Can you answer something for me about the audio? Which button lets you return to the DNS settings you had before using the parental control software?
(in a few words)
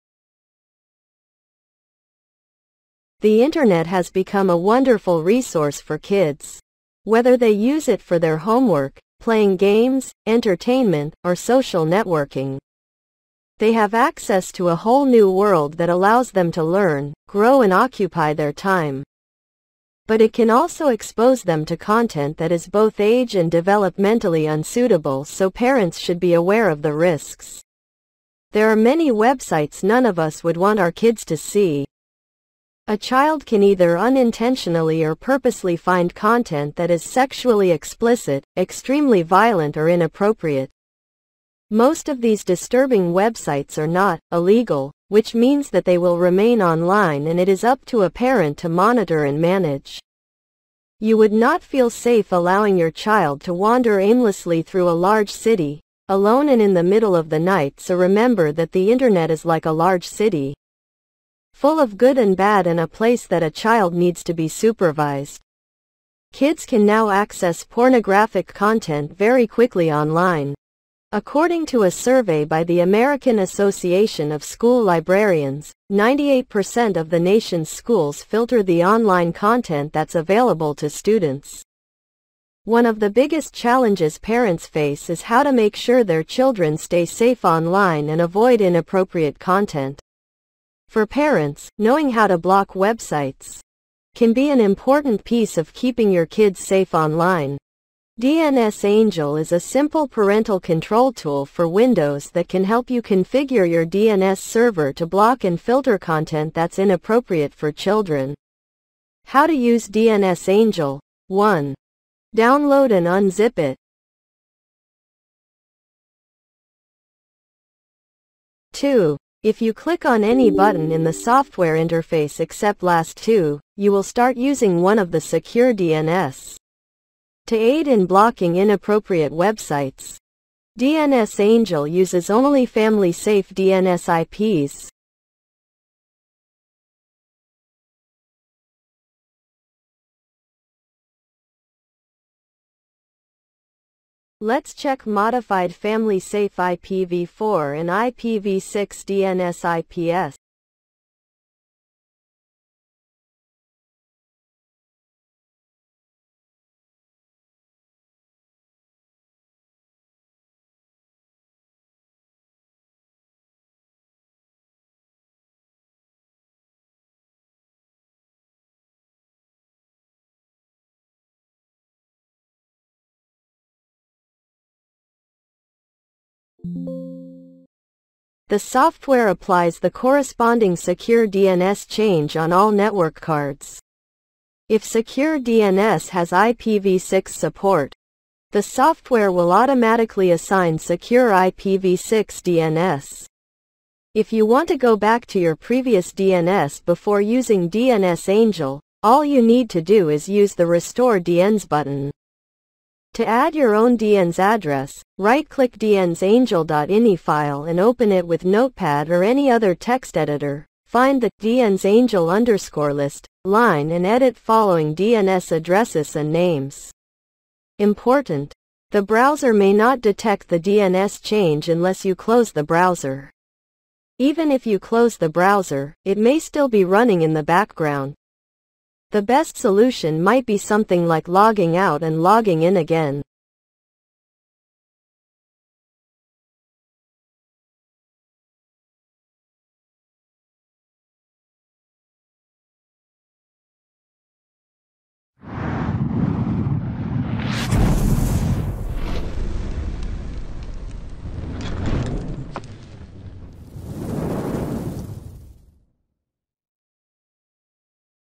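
Restore DNS.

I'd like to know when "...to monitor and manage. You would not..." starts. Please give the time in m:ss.
0:48.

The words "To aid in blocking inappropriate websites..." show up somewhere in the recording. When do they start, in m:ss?
2:07.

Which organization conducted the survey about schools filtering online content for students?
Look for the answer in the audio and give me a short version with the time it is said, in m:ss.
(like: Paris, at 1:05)
American Association of School Librarians, at 1:12.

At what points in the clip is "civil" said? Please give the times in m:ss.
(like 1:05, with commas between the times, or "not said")
not said.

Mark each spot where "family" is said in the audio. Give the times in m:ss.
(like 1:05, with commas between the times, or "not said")
2:12, 2:25.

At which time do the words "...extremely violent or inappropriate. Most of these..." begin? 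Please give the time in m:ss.
0:38.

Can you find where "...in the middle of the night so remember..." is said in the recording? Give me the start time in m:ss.
0:56.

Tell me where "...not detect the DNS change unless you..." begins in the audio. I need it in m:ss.
3:39.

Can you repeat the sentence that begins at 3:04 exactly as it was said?
If secure DNS has IPv6 support, the software will automatically assign secure IPv6 DNS.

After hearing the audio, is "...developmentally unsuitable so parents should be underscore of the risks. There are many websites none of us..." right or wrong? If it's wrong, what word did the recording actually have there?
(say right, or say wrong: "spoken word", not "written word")
wrong: "aware", not "underscore".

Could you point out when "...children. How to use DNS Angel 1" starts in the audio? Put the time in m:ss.
1:47.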